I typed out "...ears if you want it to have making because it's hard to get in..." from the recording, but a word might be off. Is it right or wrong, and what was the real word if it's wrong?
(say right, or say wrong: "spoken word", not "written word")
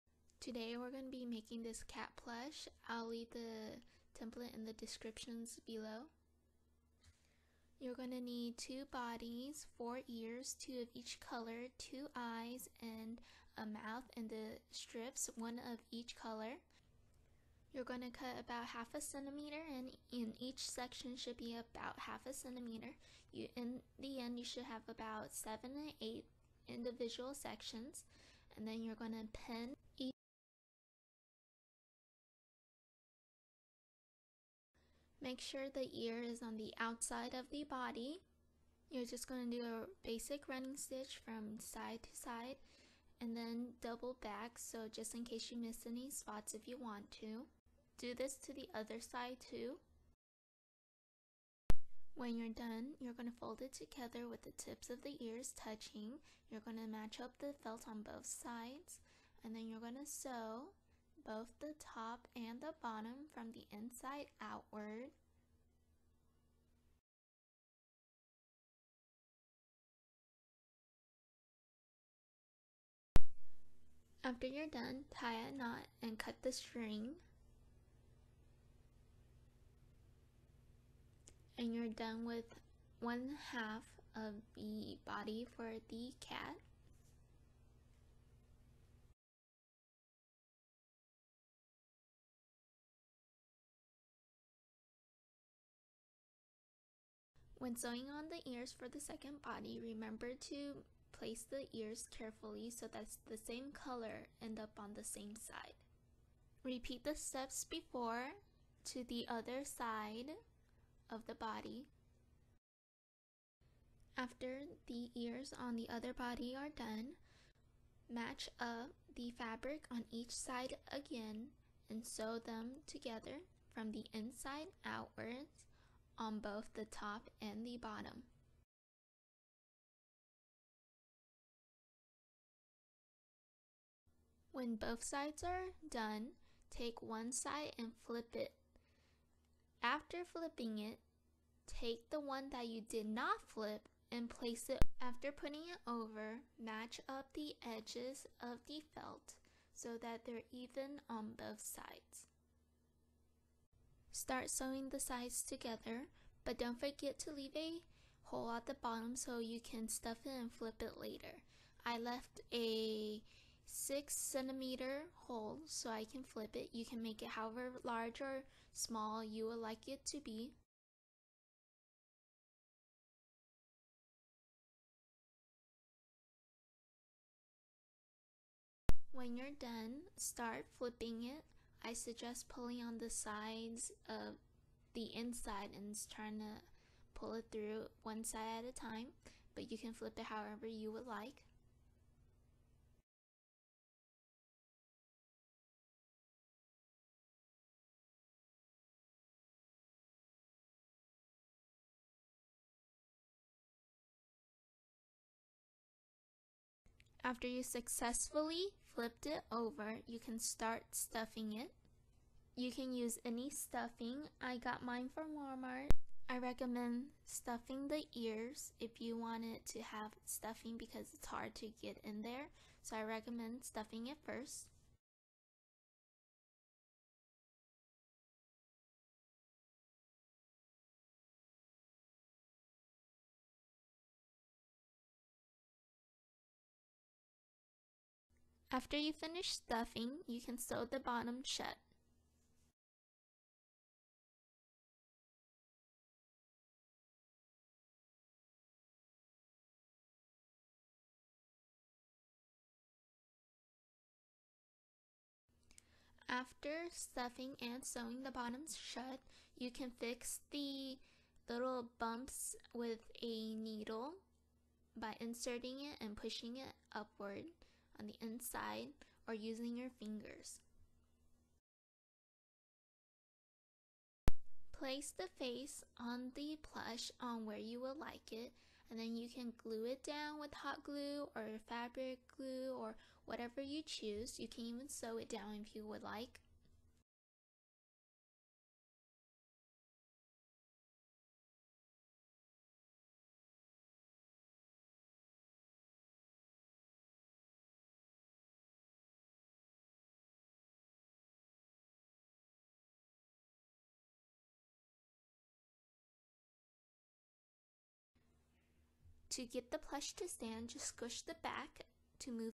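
wrong: "stuffing", not "making".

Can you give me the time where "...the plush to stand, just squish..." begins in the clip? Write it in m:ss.
5:09.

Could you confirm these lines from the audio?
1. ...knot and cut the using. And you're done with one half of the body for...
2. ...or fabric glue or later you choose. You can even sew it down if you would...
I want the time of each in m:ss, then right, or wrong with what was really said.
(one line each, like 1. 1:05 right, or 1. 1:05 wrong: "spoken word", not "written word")
1. 1:15 wrong: "string", not "using"
2. 4:41 wrong: "whatever", not "later".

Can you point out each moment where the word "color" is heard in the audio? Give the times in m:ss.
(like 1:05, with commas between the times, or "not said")
0:11, 0:16, 1:43.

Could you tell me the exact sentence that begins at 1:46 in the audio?
Repeat the steps before to the other side of the body.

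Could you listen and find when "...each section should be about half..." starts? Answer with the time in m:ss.
0:20.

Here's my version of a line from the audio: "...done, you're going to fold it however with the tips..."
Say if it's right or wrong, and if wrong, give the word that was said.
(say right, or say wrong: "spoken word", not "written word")
wrong: "together", not "however".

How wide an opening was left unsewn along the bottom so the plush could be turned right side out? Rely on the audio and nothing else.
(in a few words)
6 centimeters.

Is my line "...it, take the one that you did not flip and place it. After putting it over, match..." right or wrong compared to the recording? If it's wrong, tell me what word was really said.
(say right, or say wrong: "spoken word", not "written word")
right.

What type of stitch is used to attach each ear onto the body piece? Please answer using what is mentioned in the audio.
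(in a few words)
running stitch.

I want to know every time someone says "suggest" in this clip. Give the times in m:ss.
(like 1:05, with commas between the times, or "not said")
3:01.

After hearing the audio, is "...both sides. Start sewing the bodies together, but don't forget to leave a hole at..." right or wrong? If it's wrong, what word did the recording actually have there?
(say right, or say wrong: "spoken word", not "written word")
wrong: "sides", not "bodies".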